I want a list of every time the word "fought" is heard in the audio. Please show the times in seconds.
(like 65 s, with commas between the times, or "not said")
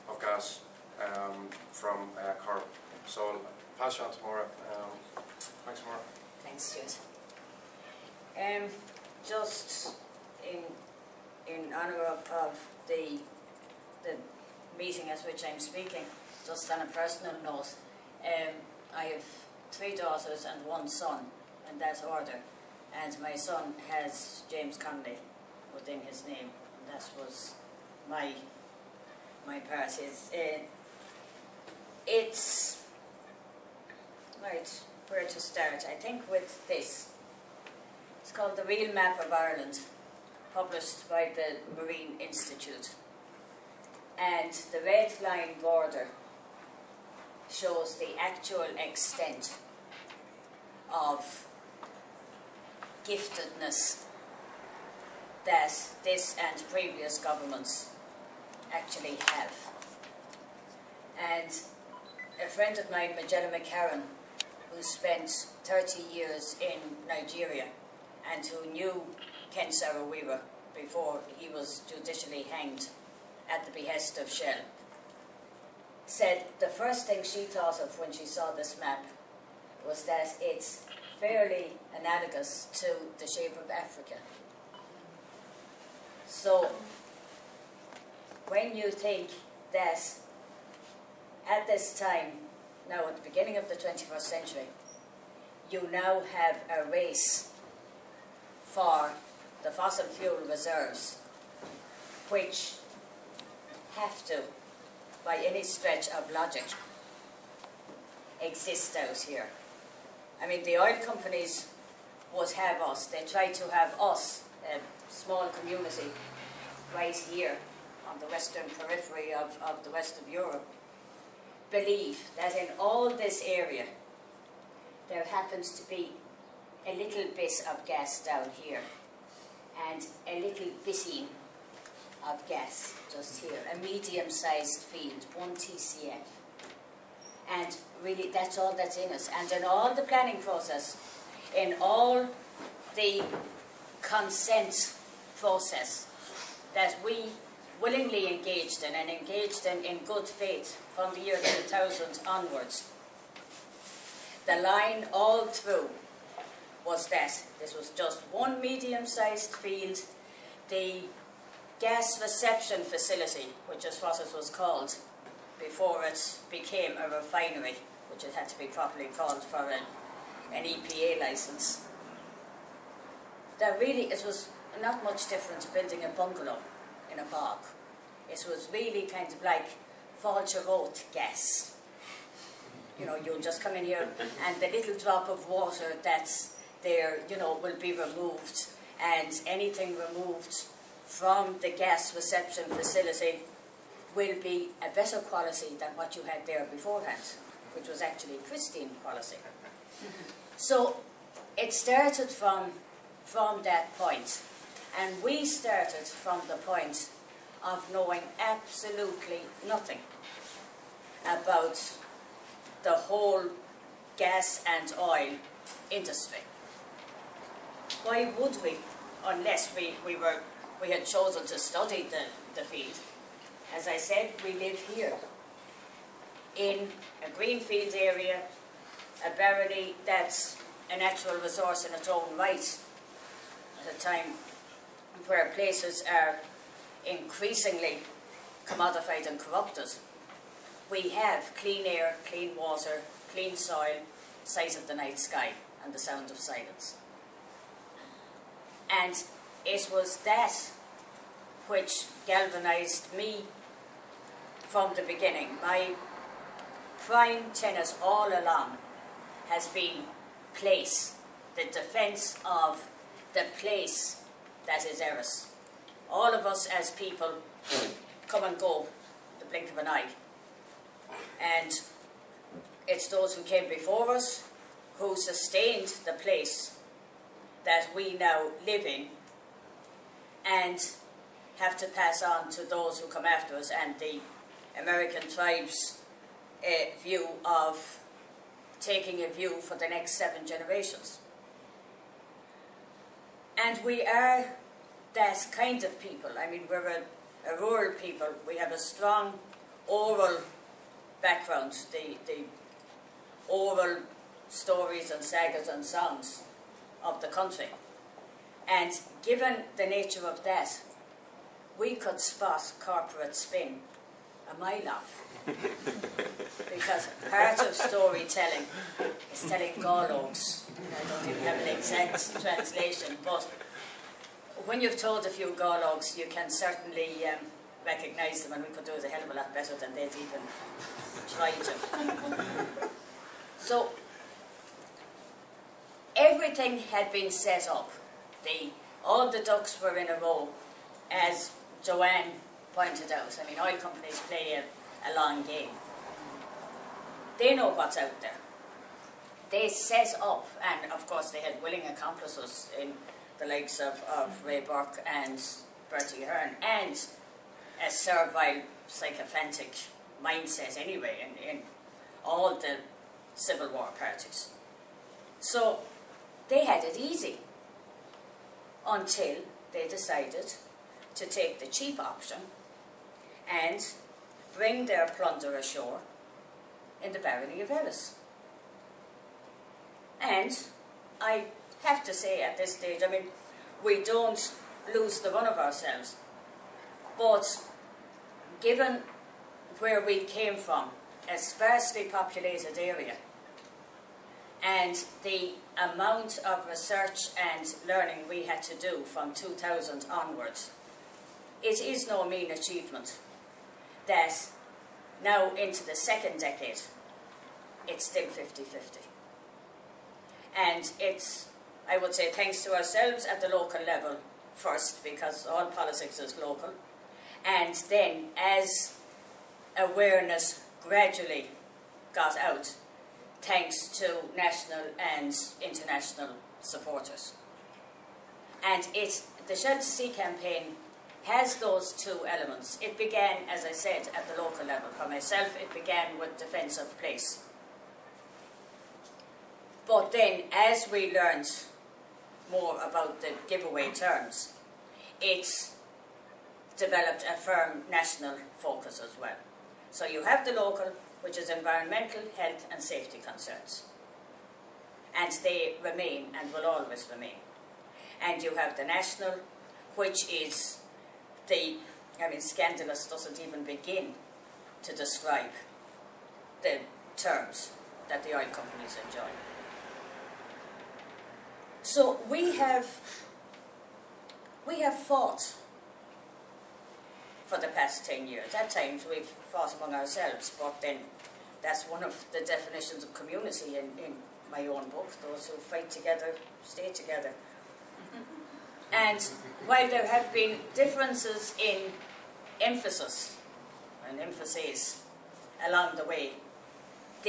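474 s, 479 s.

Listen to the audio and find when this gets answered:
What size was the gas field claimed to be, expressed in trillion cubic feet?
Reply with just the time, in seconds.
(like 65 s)
135 s.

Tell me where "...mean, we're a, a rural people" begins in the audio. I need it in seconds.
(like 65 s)
296 s.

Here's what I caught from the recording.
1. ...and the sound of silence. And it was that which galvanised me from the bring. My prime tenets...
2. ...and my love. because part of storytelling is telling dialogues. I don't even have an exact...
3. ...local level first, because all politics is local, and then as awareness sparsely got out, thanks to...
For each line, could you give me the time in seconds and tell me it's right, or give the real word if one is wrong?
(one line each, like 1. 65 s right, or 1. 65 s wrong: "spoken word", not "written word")
1. 245 s wrong: "beginning", not "bring"
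2. 314 s right
3. 413 s wrong: "gradually", not "sparsely".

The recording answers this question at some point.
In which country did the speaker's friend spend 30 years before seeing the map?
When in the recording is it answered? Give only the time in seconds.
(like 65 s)
67 s.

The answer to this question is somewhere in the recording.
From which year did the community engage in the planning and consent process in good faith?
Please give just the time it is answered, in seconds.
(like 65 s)
151 s.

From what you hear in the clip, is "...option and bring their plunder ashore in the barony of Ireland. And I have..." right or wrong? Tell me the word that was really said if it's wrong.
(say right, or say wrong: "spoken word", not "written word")
wrong: "Erris", not "Ireland".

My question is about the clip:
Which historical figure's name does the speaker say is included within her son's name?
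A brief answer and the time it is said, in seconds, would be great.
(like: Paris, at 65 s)
James Connolly, at 24 s.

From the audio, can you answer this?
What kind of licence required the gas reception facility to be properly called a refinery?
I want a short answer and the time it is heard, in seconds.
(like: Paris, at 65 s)
EPA license, at 170 s.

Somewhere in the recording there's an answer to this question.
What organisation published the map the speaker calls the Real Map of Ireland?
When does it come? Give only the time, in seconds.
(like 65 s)
41 s.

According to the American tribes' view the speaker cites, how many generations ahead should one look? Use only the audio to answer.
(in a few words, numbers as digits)
7.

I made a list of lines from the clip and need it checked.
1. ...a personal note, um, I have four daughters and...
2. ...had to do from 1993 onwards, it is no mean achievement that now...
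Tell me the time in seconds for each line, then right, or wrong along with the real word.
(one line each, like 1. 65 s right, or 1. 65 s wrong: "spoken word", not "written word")
1. 16 s wrong: "three", not "four"
2. 398 s wrong: "2000", not "1993".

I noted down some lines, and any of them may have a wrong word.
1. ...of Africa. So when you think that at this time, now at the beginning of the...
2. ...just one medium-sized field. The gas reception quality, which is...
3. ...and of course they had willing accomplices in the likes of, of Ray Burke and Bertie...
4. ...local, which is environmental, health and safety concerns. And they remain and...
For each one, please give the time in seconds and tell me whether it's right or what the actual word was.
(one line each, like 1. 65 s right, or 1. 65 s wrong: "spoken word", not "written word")
1. 83 s right
2. 157 s wrong: "facility", not "quality"
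3. 350 s right
4. 450 s right.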